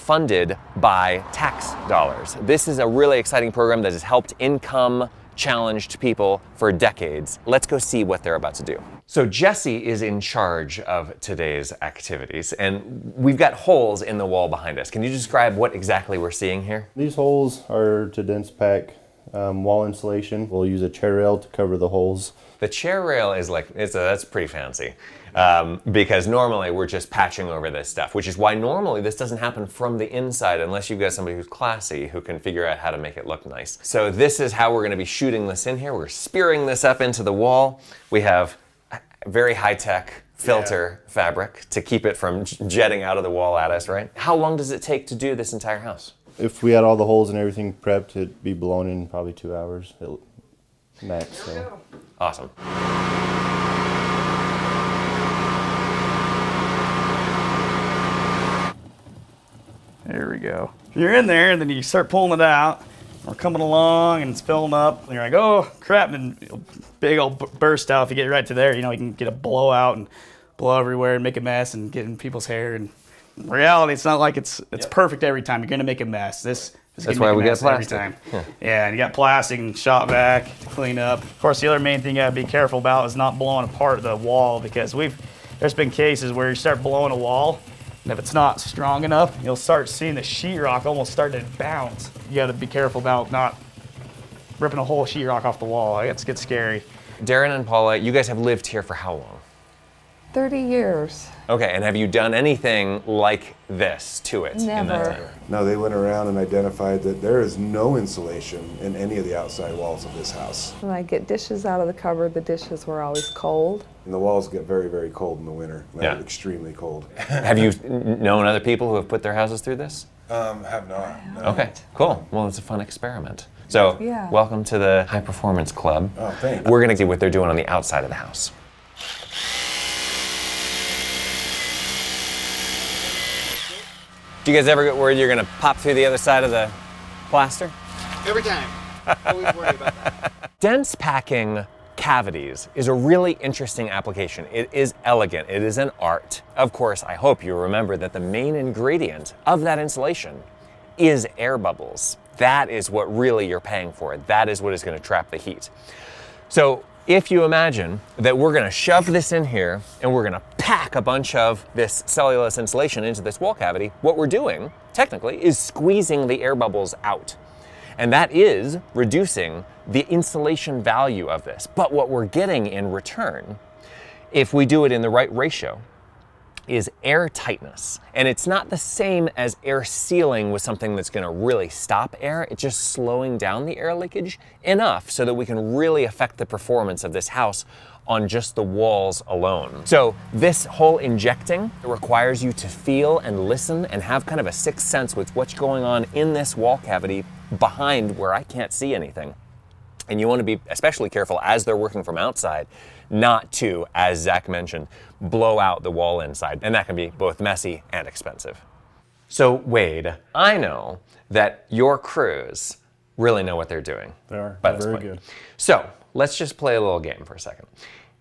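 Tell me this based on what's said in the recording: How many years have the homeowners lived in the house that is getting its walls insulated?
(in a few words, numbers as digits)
30 years.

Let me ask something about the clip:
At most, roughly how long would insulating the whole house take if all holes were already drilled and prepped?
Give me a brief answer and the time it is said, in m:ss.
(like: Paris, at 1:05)
2 hours, at 0:49.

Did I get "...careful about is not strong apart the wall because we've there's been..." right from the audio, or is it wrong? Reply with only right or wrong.
wrong.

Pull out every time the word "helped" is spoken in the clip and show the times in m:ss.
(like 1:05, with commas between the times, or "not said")
0:04.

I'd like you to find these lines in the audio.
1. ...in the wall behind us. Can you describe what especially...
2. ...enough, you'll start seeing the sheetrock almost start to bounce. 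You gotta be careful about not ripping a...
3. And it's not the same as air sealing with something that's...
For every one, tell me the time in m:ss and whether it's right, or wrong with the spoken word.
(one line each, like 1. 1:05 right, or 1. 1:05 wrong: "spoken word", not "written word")
1. 0:14 wrong: "exactly", not "especially"
2. 1:29 right
3. 2:58 right.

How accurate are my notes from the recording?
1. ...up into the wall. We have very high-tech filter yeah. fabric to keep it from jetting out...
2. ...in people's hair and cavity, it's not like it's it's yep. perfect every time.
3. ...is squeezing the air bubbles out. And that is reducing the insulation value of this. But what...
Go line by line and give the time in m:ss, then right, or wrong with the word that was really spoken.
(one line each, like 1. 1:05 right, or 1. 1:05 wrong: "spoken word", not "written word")
1. 0:36 right
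2. 1:12 wrong: "reality", not "cavity"
3. 2:45 right.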